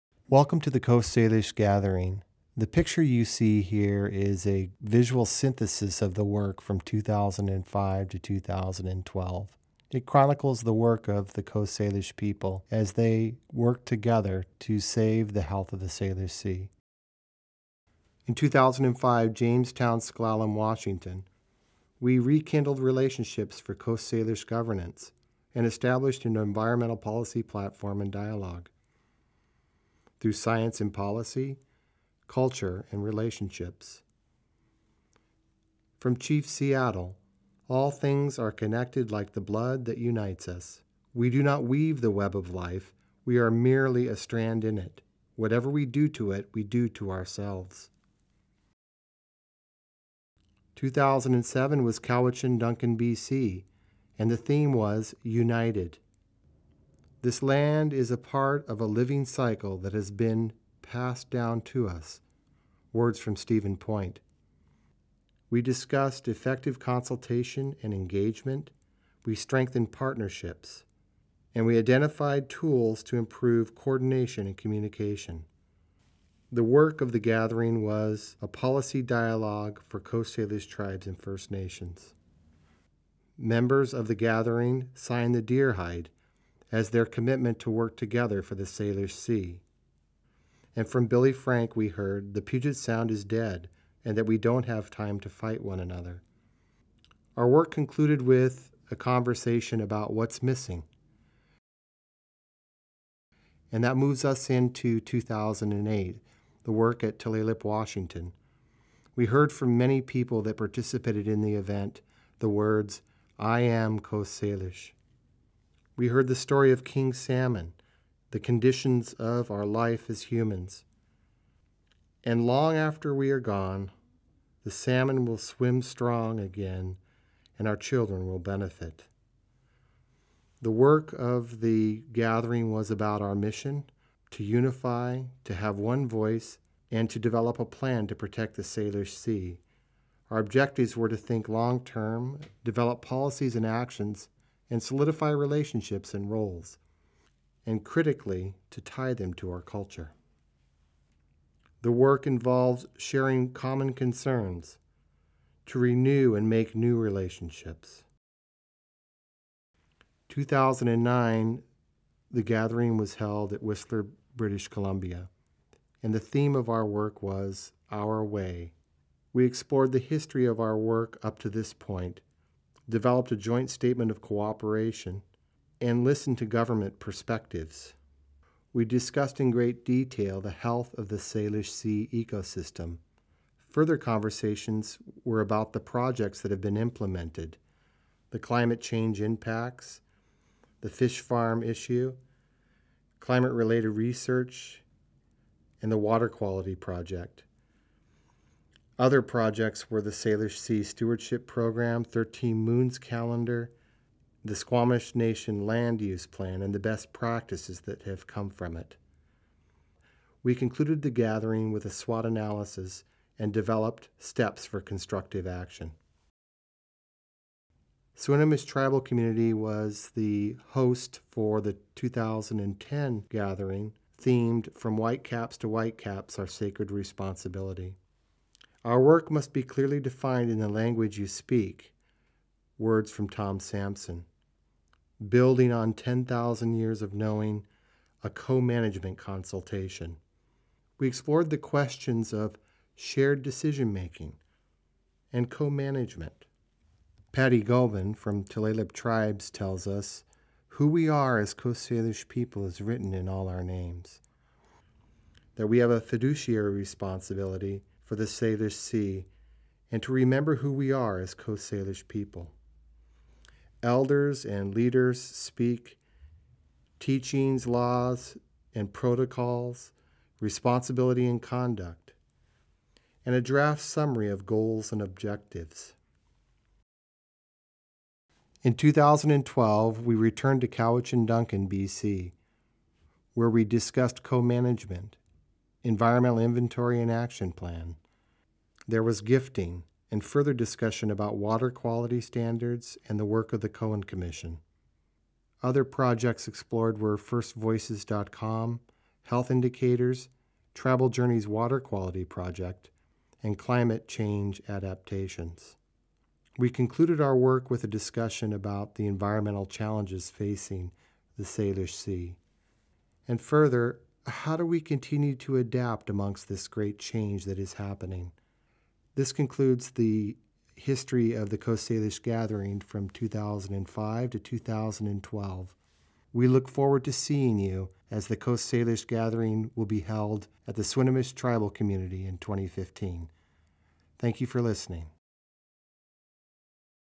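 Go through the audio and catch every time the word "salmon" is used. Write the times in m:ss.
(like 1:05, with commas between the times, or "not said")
1:57, 2:04.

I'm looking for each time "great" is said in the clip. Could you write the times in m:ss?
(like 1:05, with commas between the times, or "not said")
2:59, 5:16.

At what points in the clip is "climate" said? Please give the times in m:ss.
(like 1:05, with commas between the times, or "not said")
3:08, 3:13, 5:03.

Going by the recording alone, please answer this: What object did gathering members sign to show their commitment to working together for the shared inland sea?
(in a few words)
The Deer Hide.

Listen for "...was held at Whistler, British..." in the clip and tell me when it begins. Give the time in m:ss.
2:42.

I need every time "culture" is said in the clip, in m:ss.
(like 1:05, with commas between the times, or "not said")
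0:32, 2:29.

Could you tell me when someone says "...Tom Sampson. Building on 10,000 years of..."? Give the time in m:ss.
3:53.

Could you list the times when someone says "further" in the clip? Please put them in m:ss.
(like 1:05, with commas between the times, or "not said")
3:03, 4:50, 5:13.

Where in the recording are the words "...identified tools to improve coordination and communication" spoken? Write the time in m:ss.
1:11.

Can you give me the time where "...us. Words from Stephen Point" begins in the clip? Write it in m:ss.
1:01.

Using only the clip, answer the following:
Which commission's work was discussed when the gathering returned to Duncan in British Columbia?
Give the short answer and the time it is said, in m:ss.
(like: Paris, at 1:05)
Cohen Commission, at 4:53.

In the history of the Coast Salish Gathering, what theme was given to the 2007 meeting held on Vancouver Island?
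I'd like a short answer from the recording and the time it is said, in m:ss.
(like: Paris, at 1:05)
United, at 0:55.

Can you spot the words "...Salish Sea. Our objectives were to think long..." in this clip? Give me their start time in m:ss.
2:18.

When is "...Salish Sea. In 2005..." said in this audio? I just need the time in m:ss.
0:15.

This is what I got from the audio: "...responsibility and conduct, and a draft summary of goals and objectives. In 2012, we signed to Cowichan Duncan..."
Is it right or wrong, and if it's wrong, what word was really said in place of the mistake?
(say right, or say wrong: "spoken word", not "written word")
wrong: "returned", not "signed".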